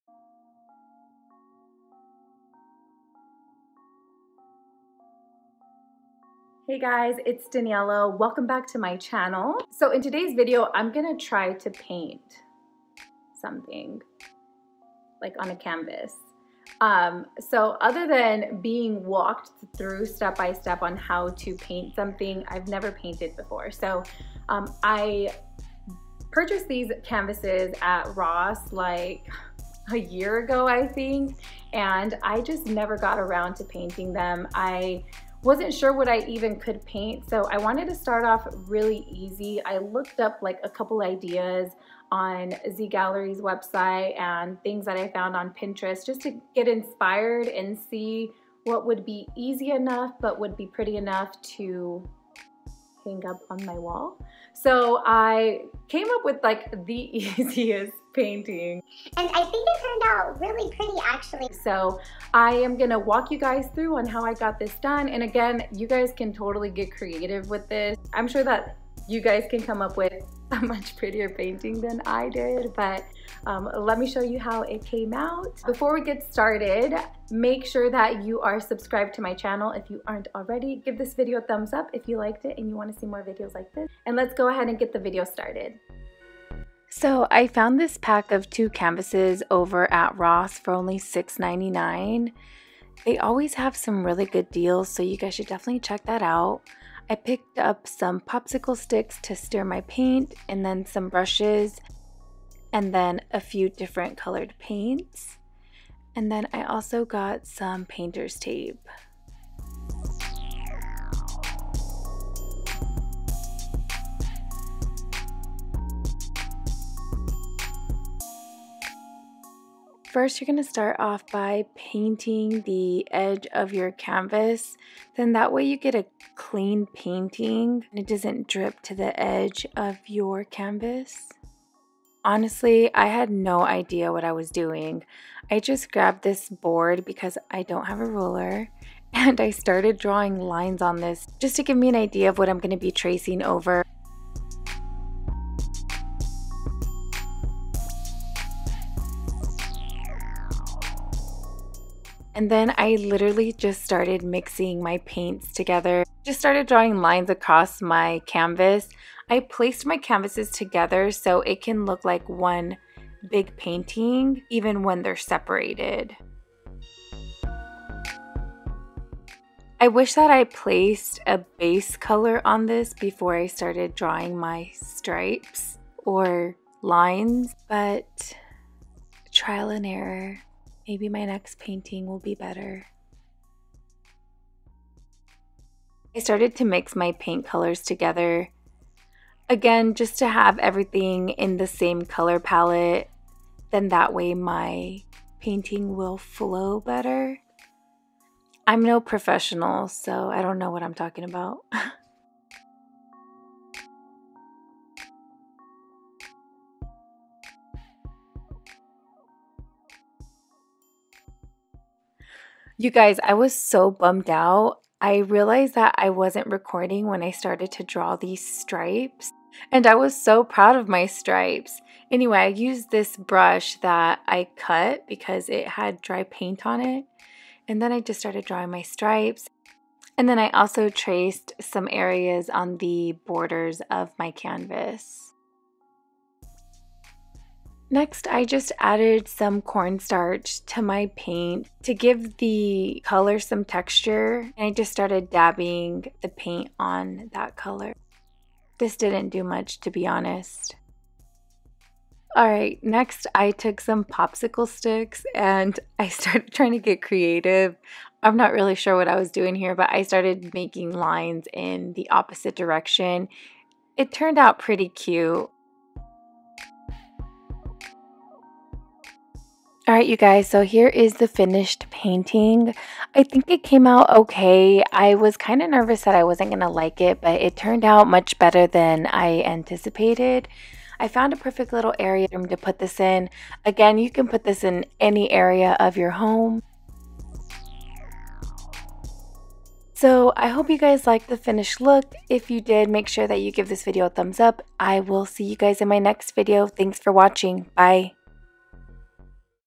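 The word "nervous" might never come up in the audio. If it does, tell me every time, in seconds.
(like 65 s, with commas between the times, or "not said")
275 s.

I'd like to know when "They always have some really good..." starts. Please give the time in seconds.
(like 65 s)
93 s.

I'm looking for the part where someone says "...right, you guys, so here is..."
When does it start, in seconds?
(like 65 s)
269 s.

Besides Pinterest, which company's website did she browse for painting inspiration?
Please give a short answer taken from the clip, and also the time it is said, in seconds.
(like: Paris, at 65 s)
Z Gallerie, at 42 s.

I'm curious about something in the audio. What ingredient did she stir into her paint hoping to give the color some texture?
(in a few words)
Cornstarch.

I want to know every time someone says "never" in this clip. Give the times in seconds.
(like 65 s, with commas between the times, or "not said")
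22 s, 32 s.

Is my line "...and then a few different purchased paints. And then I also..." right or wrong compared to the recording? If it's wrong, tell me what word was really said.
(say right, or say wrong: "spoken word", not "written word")
wrong: "colored", not "purchased".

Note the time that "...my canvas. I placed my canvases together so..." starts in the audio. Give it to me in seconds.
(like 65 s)
157 s.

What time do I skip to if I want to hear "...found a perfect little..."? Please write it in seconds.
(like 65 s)
281 s.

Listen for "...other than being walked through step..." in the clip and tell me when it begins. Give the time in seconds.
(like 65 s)
17 s.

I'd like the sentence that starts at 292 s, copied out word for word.
If you did, make sure that you give this video a thumbs up.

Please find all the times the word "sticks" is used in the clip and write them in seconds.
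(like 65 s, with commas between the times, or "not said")
98 s, 254 s.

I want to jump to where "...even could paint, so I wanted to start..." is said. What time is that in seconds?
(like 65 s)
36 s.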